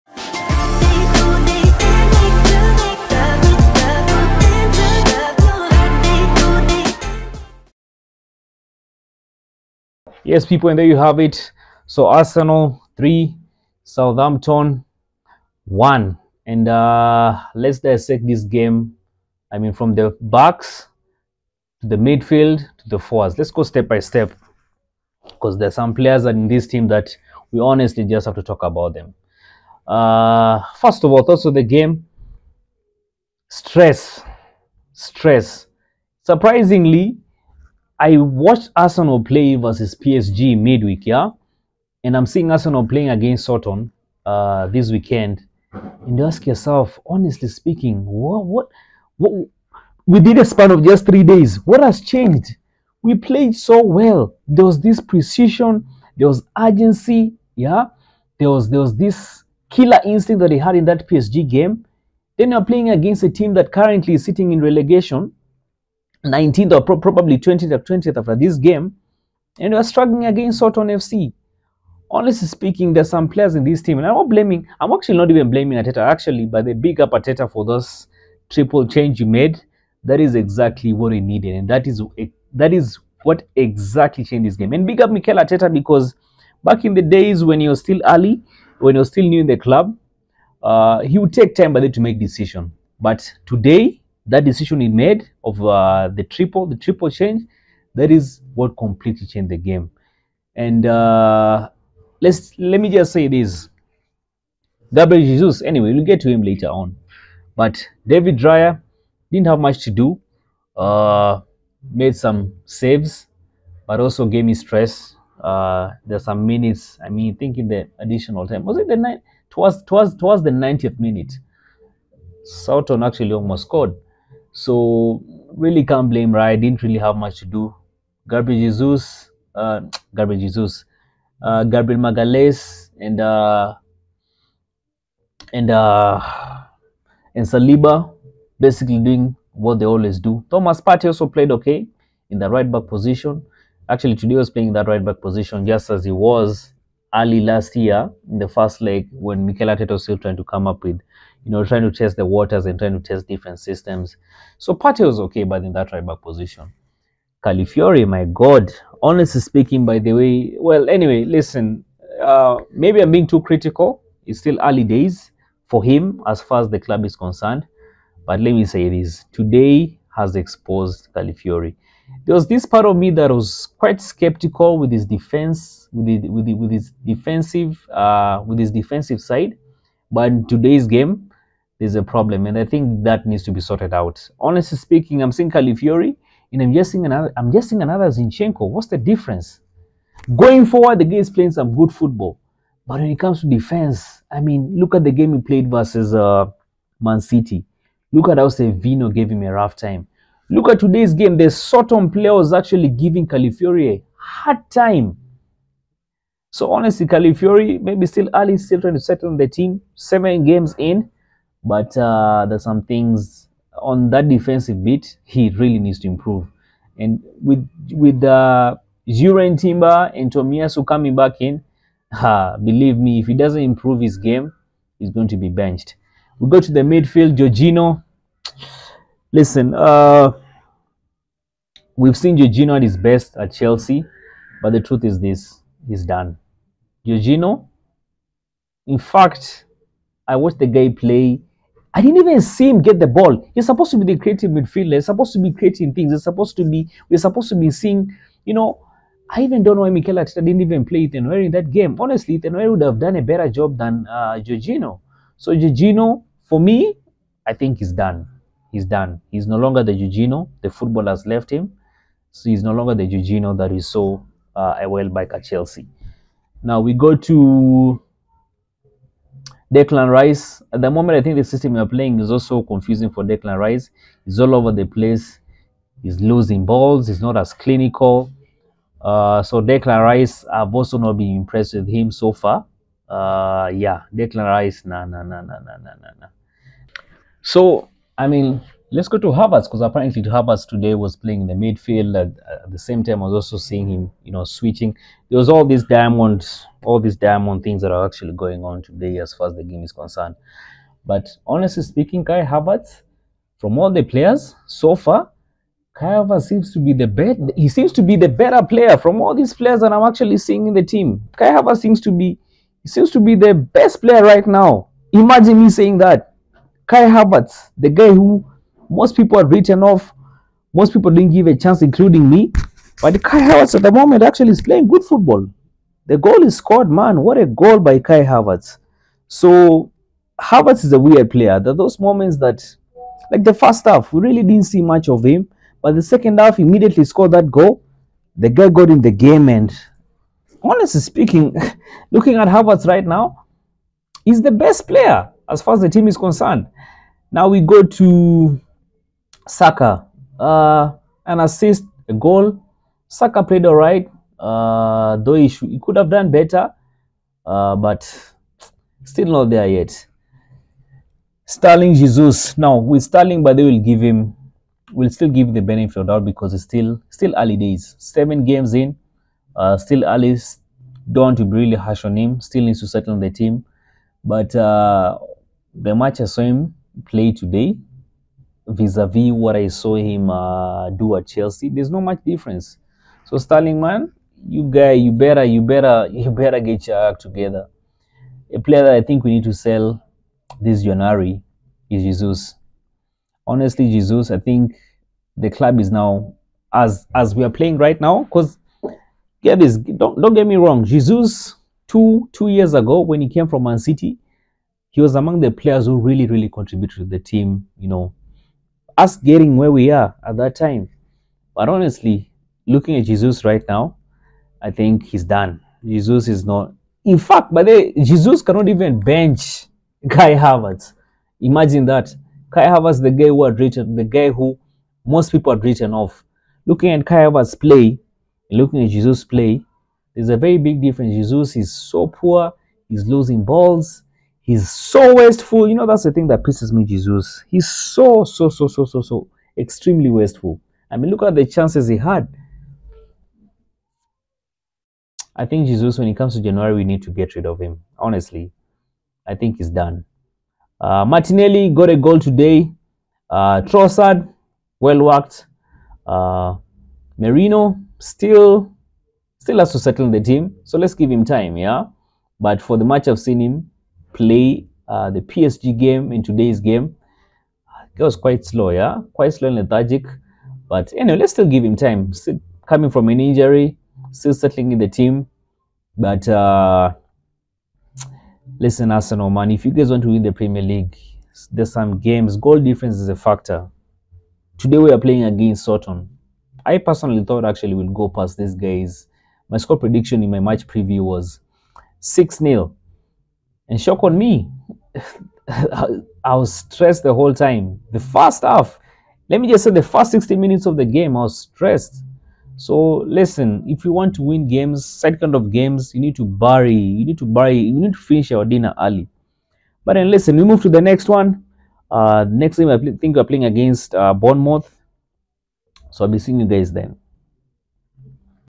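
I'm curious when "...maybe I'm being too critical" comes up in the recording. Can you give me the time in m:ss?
2:42.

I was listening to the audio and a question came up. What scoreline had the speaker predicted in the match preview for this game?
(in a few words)
6-0.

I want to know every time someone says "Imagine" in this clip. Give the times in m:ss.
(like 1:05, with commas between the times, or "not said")
5:15, 7:01.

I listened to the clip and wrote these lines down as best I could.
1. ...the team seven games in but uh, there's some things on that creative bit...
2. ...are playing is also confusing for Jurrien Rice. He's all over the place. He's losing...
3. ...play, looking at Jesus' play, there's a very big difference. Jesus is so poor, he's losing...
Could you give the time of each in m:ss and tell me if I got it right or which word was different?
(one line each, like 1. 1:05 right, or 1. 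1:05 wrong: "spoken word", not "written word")
1. 3:29 wrong: "defensive", not "creative"
2. 4:31 wrong: "Declan", not "Jurrien"
3. 7:07 right.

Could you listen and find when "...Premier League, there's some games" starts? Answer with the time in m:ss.
8:00.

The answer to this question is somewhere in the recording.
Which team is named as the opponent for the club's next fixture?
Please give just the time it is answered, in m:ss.
8:34.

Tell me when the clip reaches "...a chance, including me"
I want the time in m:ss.
5:21.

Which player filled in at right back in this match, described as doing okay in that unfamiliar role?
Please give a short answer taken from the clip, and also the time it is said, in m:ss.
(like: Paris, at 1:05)
Thomas Partey, at 2:20.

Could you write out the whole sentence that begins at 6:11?
Don't want to be really harsh on him.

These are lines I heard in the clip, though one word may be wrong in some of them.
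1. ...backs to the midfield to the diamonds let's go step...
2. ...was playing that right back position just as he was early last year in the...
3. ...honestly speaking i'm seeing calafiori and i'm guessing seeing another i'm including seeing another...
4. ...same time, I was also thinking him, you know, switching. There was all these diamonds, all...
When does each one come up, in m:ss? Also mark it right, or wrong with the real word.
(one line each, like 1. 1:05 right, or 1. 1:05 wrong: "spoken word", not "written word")
1. 0:20 wrong: "forwards", not "diamonds"
2. 2:24 right
3. 3:04 wrong: "guessing", not "including"
4. 4:52 wrong: "seeing", not "thinking".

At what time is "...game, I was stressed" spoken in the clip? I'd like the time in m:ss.
8:20.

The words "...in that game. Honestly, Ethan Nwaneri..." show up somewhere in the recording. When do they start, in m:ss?
4:11.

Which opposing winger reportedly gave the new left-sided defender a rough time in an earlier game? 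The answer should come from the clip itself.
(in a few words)
Savinho.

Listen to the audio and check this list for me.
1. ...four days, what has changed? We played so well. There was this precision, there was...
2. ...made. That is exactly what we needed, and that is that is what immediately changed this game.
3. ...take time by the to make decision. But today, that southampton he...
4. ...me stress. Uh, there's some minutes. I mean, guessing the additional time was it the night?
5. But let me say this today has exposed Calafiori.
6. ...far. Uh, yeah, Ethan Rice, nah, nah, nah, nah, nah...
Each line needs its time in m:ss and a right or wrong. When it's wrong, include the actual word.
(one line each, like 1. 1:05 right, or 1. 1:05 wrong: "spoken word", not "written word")
1. 0:51 wrong: "three", not "four"
2. 1:19 wrong: "exactly", not "immediately"
3. 1:31 wrong: "decision", not "southampton"
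4. 1:54 wrong: "thinking", not "guessing"
5. 2:48 right
6. 4:42 wrong: "Declan", not "Ethan".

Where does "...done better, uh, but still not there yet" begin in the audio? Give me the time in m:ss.
5:56.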